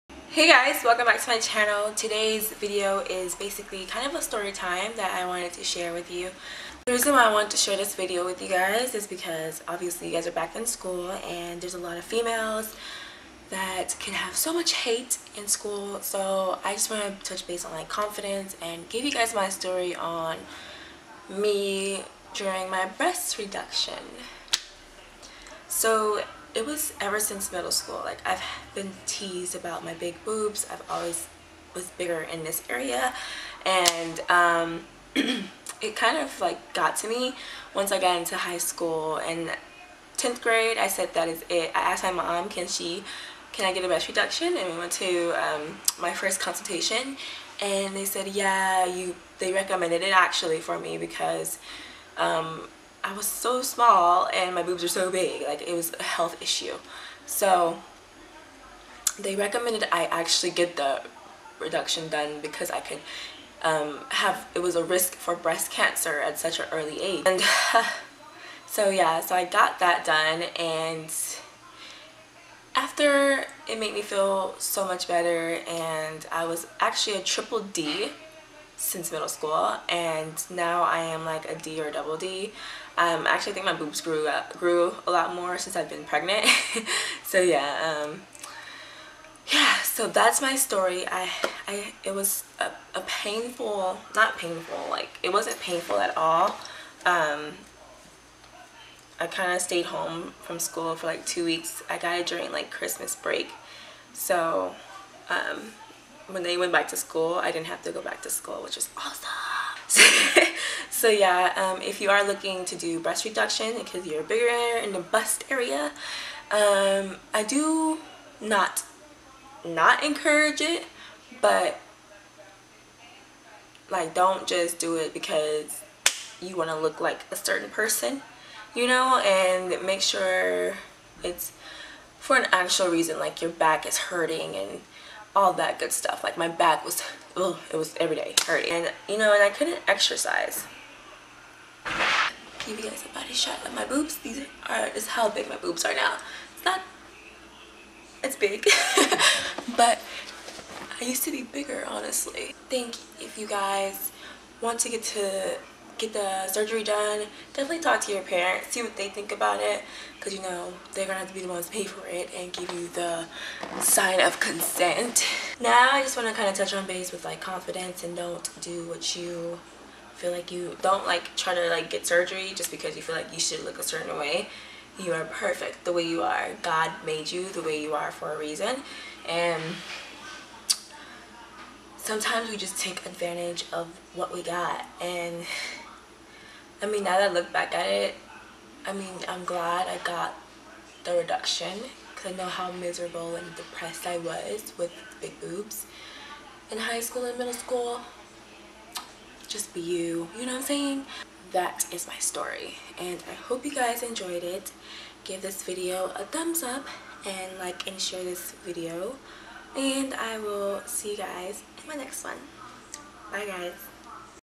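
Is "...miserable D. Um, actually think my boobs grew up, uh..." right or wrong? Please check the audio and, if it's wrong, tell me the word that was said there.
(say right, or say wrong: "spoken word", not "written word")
wrong: "double", not "miserable".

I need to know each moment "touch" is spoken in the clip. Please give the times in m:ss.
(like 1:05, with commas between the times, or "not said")
0:17, 2:46.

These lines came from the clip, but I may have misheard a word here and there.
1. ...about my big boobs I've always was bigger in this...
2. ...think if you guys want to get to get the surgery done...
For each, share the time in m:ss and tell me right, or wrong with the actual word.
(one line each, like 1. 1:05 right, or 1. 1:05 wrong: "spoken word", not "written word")
1. 0:29 right
2. 2:32 right.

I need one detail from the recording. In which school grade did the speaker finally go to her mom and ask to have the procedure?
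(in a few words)
10th grade.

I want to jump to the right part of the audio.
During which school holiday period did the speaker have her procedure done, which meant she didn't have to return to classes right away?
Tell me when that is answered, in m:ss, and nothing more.
1:42.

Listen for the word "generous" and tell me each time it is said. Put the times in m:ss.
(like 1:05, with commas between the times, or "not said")
not said.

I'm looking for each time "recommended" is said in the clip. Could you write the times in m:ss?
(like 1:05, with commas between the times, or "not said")
0:49, 0:59.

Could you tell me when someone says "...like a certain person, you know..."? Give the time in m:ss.
2:07.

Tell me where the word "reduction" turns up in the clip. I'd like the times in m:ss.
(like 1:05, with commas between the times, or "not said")
0:23, 0:44, 1:01, 1:53, 3:11.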